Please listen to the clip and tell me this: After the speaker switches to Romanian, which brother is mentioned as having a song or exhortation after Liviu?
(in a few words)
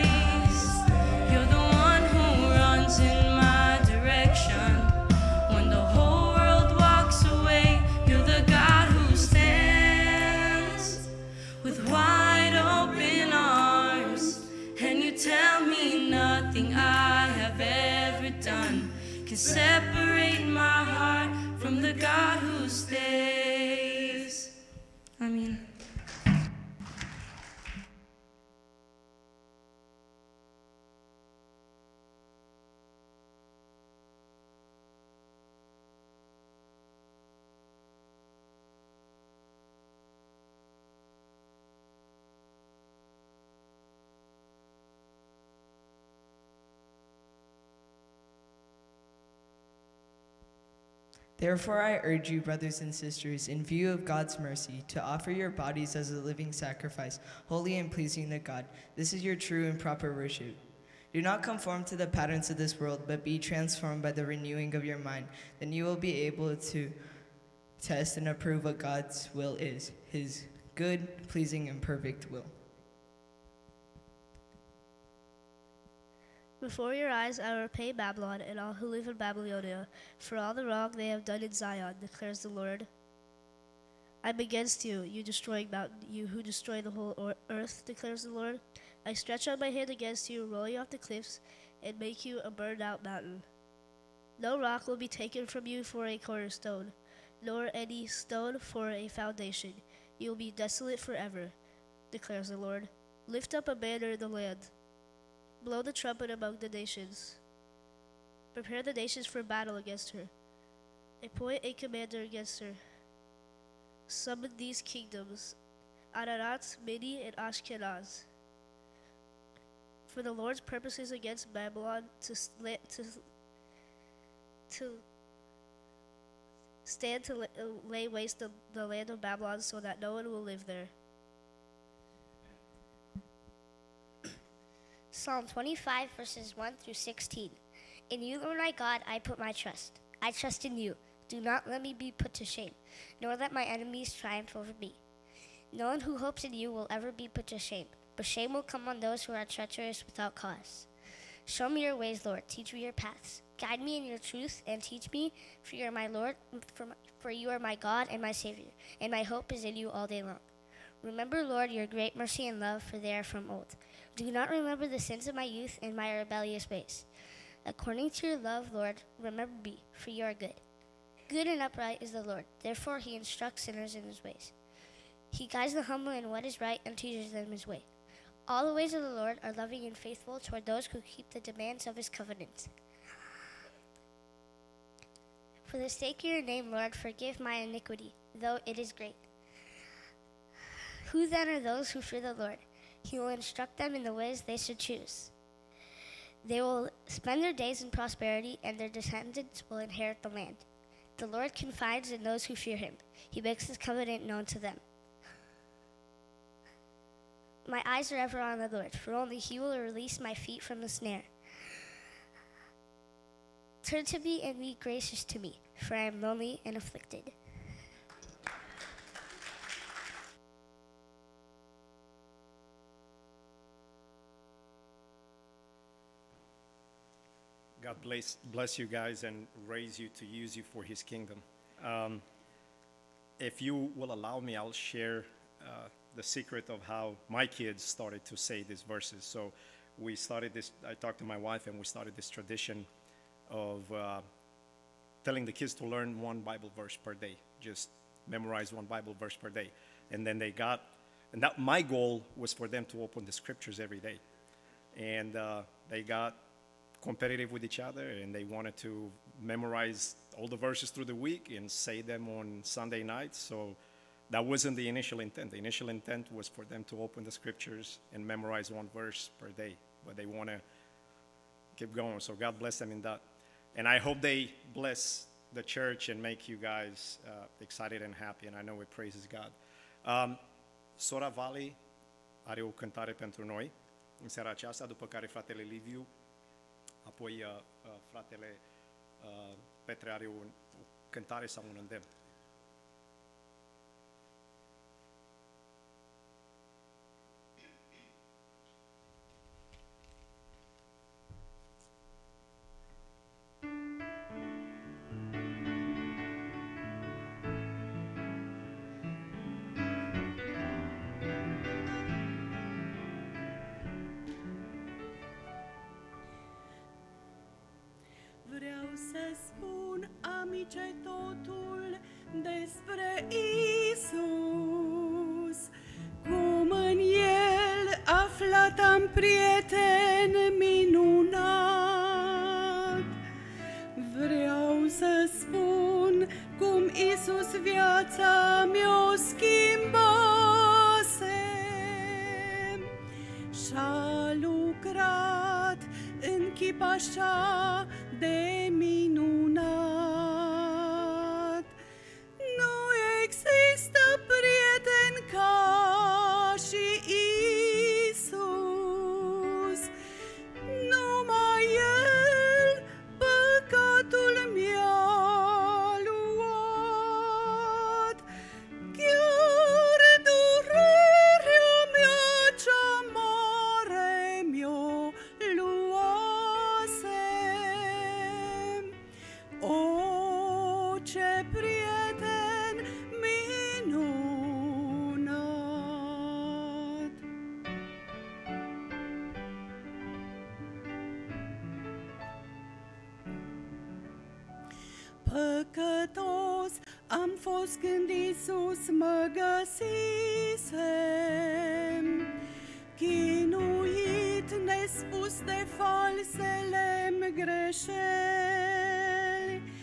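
Petre.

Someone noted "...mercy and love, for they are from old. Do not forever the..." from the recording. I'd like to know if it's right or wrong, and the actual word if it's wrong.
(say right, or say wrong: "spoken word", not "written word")
wrong: "remember", not "forever".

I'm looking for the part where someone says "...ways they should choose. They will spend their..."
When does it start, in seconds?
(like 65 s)
194 s.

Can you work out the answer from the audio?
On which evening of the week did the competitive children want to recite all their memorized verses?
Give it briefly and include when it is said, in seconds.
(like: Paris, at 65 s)
Sunday night, at 262 s.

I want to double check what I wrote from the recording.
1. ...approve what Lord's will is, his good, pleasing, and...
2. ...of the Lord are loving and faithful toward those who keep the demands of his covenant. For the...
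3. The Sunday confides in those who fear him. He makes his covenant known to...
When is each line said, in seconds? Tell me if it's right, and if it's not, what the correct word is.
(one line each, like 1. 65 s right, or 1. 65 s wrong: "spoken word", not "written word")
1. 68 s wrong: "God", not "Lord"
2. 178 s right
3. 201 s wrong: "Lord", not "Sunday".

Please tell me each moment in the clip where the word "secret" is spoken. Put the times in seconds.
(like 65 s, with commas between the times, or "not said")
236 s.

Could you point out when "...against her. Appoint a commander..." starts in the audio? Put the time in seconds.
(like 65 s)
109 s.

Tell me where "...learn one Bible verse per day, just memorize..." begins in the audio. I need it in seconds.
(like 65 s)
245 s.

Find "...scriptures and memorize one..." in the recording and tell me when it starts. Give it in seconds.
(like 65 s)
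267 s.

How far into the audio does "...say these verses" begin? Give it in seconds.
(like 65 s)
238 s.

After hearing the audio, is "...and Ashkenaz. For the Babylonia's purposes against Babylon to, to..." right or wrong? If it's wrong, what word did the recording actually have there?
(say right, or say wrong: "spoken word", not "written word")
wrong: "Lord", not "Babylonia".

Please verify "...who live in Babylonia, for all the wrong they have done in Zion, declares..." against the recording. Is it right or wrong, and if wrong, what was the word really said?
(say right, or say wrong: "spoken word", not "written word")
right.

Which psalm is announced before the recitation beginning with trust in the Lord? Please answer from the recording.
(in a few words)
Psalm 25.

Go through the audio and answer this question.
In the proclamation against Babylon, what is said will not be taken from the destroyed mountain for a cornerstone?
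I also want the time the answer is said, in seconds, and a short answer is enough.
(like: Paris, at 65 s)
No rock, at 94 s.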